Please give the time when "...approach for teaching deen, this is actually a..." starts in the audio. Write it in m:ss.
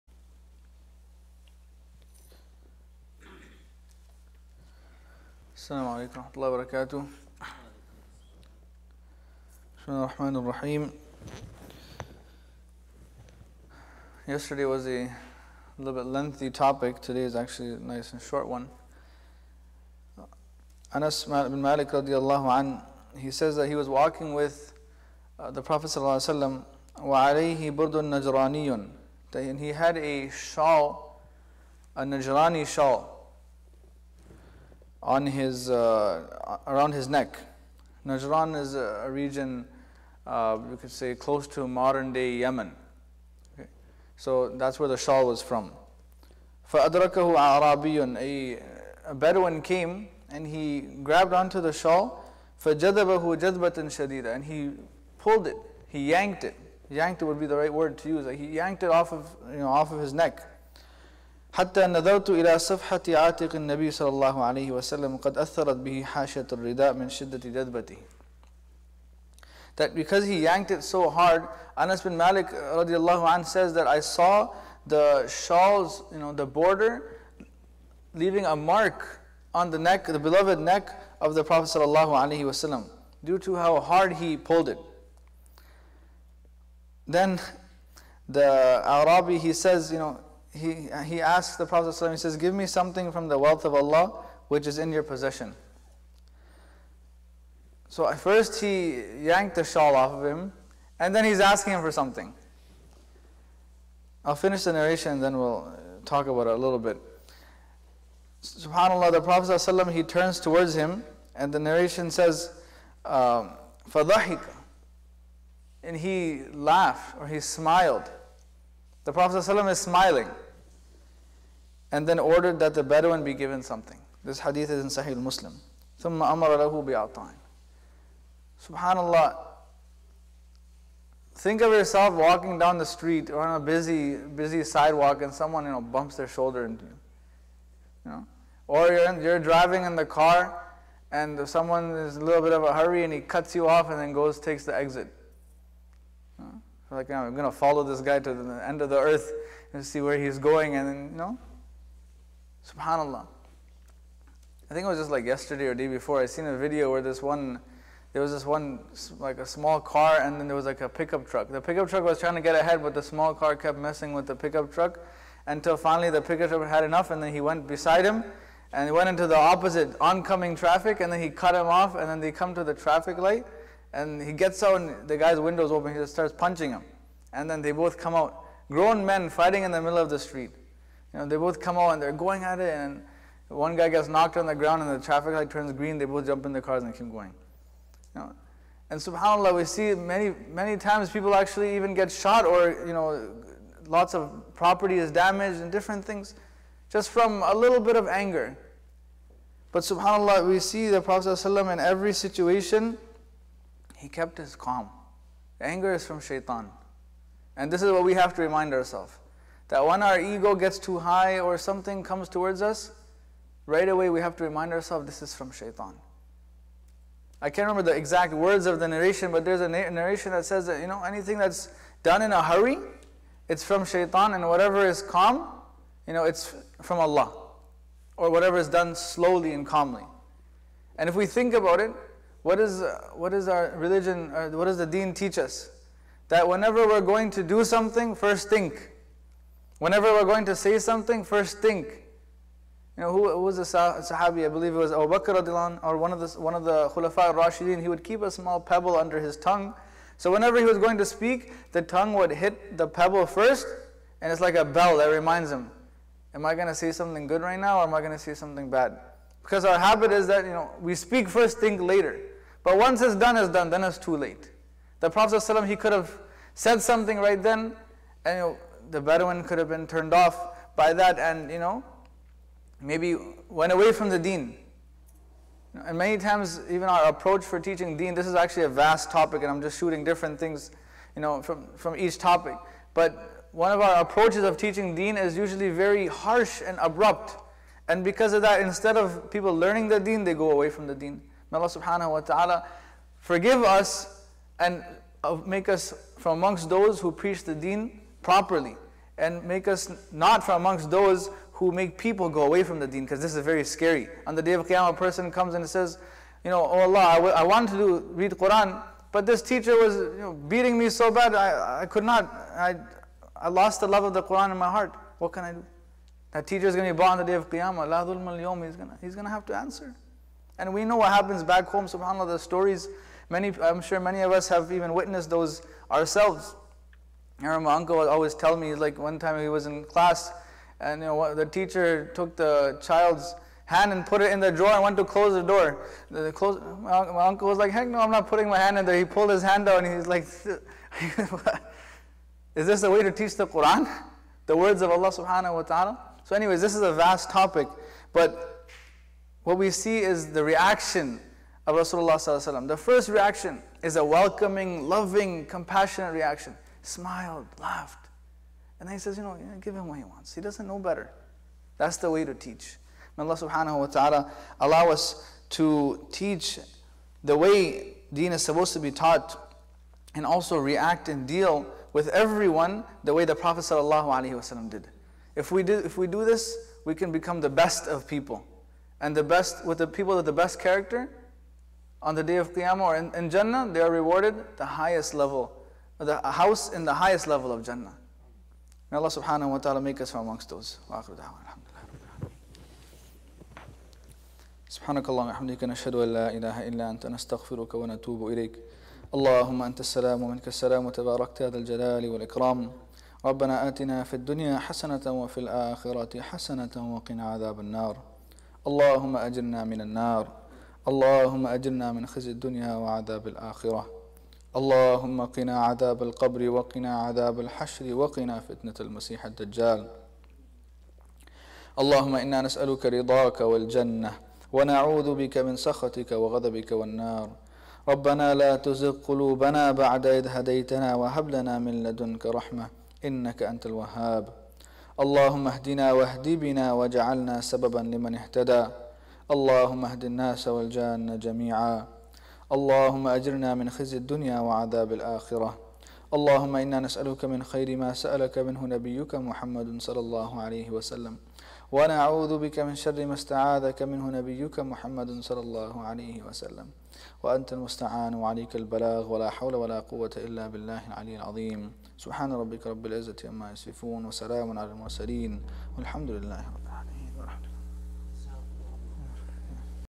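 4:37.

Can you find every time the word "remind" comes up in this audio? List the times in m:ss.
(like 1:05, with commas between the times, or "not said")
3:28, 3:34, 4:15.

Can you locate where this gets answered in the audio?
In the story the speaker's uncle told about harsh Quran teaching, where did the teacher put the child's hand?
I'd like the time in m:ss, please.
5:34.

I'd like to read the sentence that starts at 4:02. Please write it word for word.
You know, who, who was the sah Sahabi?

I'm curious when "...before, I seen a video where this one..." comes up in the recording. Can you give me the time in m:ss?
2:35.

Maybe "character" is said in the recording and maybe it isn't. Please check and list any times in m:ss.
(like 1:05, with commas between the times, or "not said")
6:20.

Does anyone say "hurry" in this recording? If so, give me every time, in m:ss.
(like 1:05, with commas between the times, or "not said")
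2:22, 3:42.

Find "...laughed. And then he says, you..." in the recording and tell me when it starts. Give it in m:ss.
5:57.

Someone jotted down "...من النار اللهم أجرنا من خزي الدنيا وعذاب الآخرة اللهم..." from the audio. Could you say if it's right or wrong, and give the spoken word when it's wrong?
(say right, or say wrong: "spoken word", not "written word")
right.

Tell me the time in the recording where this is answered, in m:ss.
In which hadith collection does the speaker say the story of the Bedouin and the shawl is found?
2:05.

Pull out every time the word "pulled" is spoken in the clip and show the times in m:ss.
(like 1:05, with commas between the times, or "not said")
0:55, 1:24, 5:39.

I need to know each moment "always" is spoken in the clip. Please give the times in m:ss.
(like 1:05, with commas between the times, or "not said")
5:28.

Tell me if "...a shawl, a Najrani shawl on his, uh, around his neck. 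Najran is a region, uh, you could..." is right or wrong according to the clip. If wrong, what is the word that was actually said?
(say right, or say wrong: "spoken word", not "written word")
right.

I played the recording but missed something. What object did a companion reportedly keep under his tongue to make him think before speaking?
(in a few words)
A small pebble.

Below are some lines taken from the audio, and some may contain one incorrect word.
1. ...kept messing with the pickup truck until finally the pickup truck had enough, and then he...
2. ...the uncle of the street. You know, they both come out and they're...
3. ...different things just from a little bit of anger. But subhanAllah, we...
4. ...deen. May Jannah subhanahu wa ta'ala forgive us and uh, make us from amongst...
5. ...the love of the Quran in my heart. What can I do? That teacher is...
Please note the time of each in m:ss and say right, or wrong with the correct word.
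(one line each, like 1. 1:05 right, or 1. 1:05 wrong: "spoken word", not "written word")
1. 2:43 right
2. 2:59 wrong: "middle", not "uncle"
3. 3:15 right
4. 4:50 wrong: "Allah", not "Jannah"
5. 5:13 right.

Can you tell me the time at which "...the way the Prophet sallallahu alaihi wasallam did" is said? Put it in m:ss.
6:13.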